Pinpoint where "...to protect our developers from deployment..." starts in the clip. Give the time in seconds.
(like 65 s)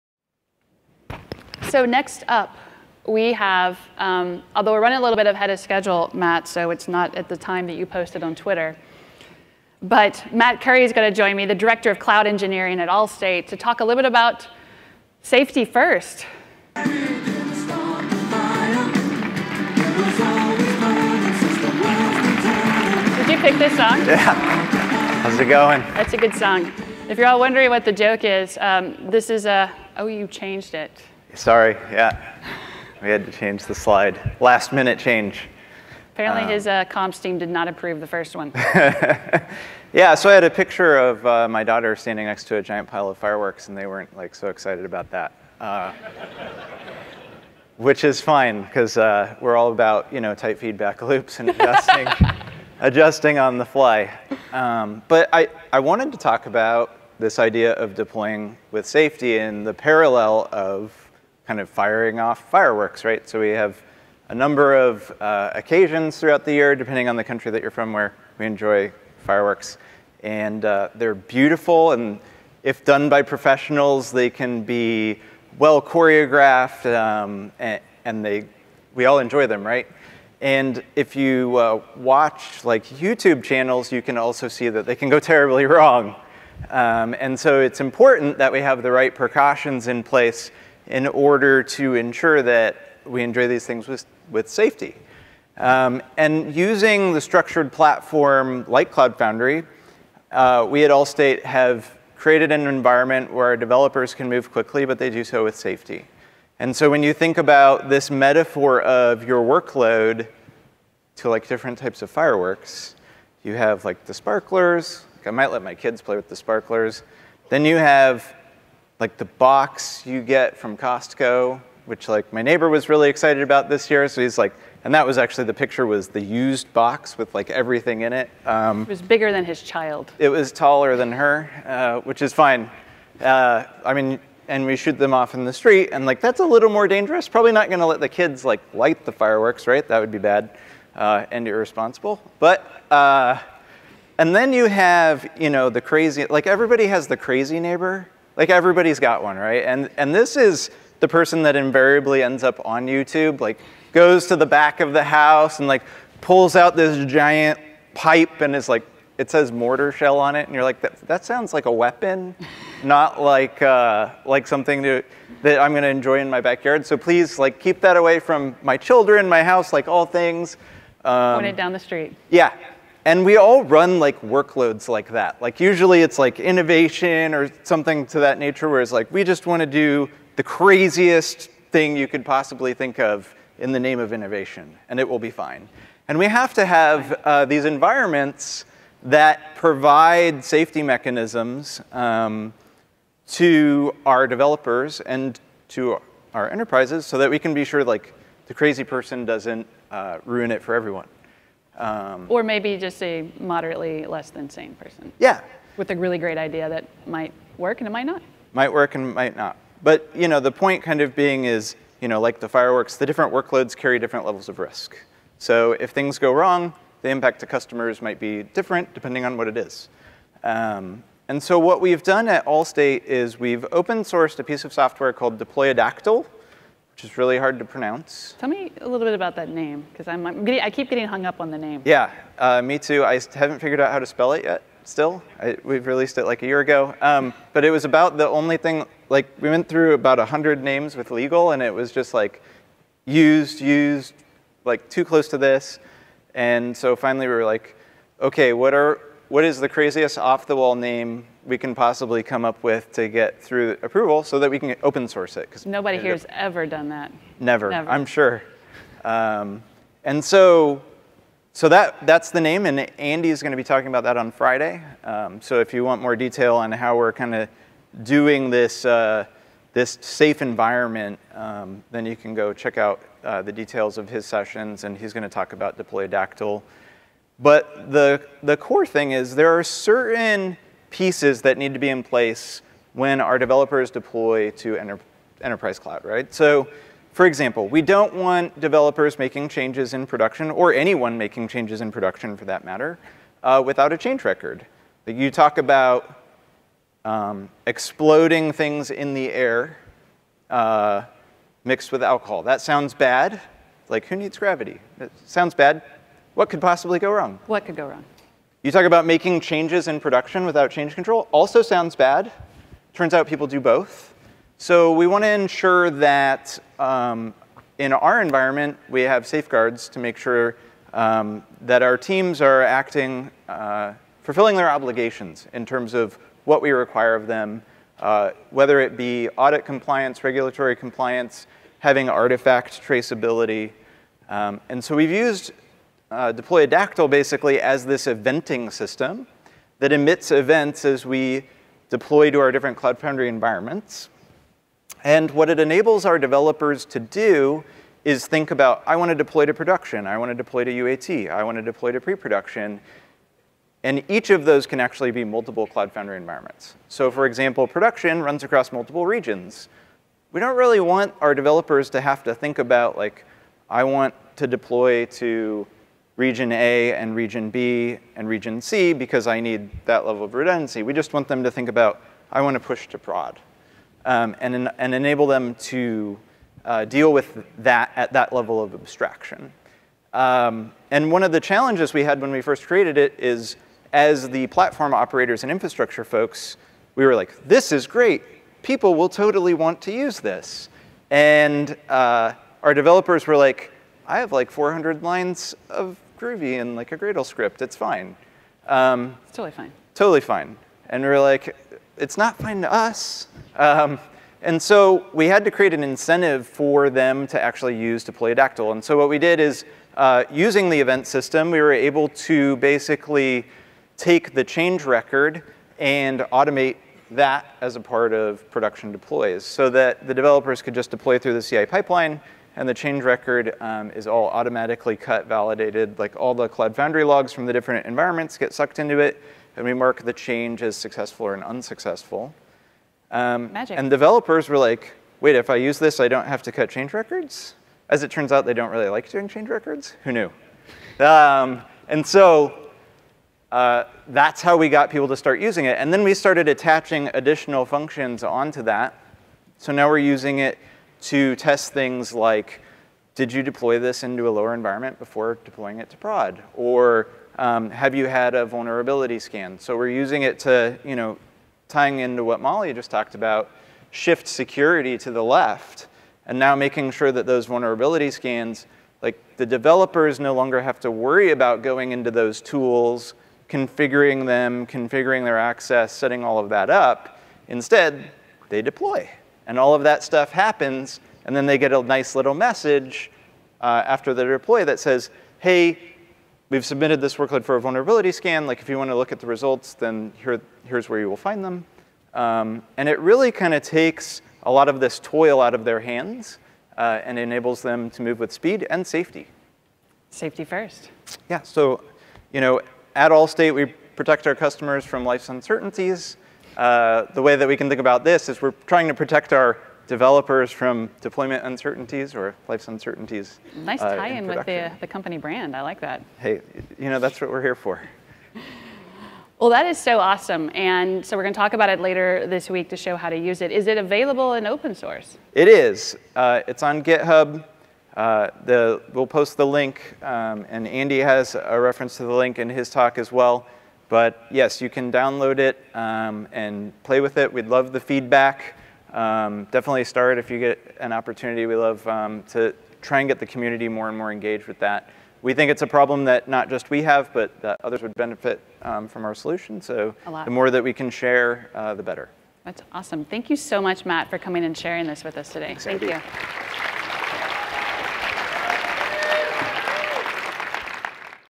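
508 s.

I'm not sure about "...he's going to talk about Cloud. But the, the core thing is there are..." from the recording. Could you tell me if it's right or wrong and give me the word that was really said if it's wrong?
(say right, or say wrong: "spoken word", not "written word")
wrong: "Dactyl", not "Cloud".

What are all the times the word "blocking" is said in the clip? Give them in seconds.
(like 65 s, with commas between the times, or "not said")
not said.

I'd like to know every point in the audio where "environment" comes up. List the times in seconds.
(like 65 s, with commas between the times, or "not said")
102 s, 187 s, 270 s, 318 s, 343 s, 356 s, 427 s, 454 s.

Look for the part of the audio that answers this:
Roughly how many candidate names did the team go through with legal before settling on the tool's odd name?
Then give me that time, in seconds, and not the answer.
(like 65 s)
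240 s.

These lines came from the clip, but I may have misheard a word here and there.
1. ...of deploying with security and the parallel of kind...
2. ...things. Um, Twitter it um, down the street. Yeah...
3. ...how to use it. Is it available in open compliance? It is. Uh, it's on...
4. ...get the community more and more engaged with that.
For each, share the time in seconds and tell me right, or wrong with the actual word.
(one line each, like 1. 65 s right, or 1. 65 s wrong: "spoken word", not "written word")
1. 57 s wrong: "safety", not "security"
2. 170 s wrong: "Point", not "Twitter"
3. 522 s wrong: "source", not "compliance"
4. 543 s right.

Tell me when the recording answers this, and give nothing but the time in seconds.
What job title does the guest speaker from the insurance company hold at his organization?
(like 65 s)
11 s.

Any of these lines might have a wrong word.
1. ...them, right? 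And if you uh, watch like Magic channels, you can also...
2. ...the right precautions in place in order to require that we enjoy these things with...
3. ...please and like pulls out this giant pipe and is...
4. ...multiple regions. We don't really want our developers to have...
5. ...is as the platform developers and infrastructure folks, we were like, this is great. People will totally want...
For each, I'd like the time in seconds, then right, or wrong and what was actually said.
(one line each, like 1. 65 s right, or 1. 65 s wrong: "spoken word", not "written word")
1. 79 s wrong: "YouTube", not "Magic"
2. 88 s wrong: "ensure", not "require"
3. 155 s wrong: "house", not "please"
4. 358 s right
5. 383 s wrong: "operators", not "developers".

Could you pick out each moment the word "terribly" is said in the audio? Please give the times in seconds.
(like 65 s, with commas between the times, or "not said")
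85 s.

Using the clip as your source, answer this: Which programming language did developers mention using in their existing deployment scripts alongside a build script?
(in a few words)
Groovy.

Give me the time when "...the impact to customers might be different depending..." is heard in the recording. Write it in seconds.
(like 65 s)
217 s.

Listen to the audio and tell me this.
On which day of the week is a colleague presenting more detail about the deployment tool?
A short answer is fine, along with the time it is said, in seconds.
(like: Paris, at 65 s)
Friday, at 264 s.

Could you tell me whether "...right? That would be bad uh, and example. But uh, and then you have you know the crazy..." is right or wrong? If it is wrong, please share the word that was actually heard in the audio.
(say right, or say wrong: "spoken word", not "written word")
wrong: "irresponsible", not "example".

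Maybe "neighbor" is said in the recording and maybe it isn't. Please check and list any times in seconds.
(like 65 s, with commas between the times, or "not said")
122 s, 147 s.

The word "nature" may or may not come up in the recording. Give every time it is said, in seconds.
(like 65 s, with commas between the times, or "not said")
178 s.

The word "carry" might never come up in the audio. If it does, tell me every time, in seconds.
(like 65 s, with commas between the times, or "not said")
213 s.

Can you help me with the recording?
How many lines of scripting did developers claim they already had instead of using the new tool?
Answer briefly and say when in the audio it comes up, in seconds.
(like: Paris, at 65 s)
400, at 394 s.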